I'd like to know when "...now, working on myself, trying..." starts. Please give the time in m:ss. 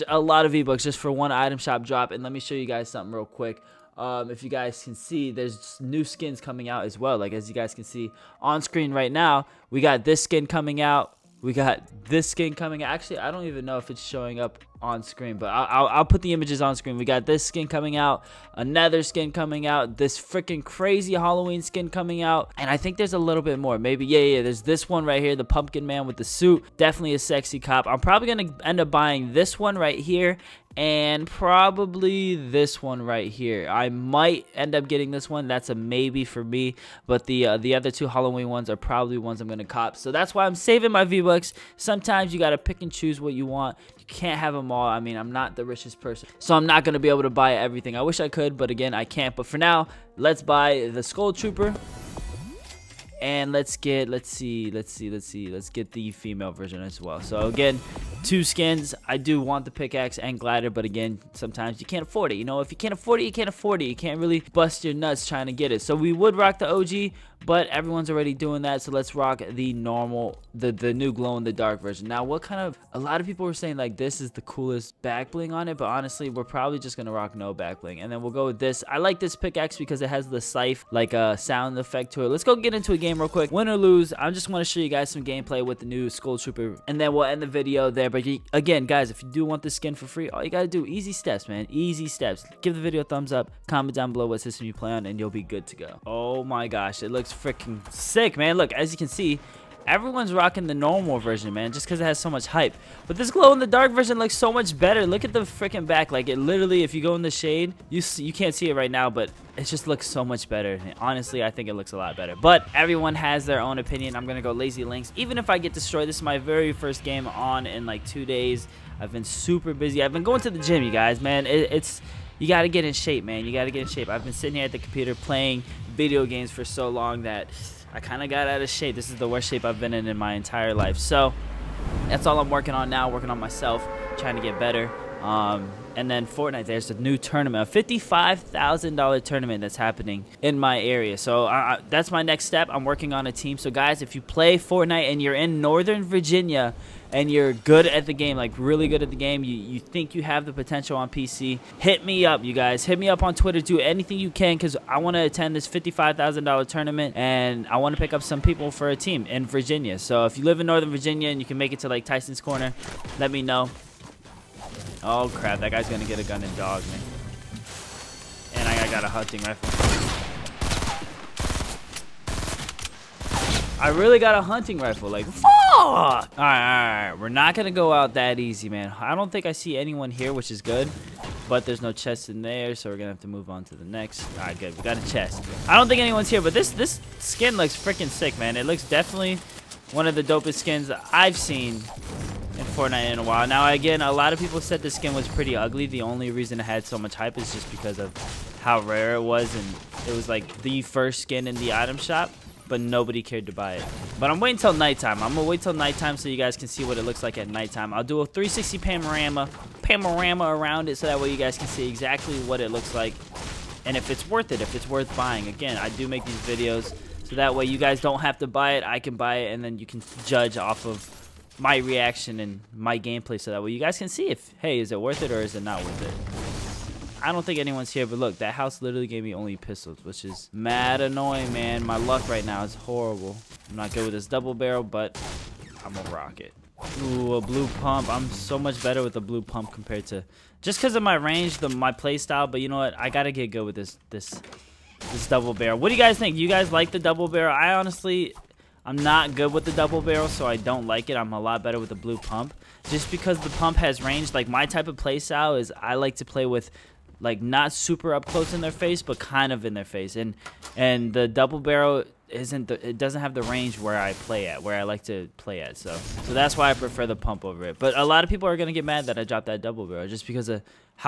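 2:12.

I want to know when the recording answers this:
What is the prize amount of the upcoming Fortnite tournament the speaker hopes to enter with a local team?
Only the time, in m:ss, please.
2:17.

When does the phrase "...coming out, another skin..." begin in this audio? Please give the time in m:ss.
0:17.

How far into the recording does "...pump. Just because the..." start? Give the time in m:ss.
4:12.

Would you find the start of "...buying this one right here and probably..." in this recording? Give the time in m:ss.
0:28.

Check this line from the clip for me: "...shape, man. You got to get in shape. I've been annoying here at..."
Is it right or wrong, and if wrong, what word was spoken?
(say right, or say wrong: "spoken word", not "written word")
wrong: "sitting", not "annoying".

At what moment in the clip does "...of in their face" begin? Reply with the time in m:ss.
4:19.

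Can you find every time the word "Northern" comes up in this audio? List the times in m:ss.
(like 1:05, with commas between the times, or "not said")
2:25, 2:40.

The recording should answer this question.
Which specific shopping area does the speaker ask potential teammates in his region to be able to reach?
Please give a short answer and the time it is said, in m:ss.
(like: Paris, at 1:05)
Tyson's Corner, at 2:42.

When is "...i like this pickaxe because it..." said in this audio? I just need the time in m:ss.
1:18.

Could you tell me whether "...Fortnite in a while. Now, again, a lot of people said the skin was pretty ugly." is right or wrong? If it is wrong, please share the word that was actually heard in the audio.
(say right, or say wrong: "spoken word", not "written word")
right.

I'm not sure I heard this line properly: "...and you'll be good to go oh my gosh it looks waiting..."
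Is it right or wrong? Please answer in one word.
wrong.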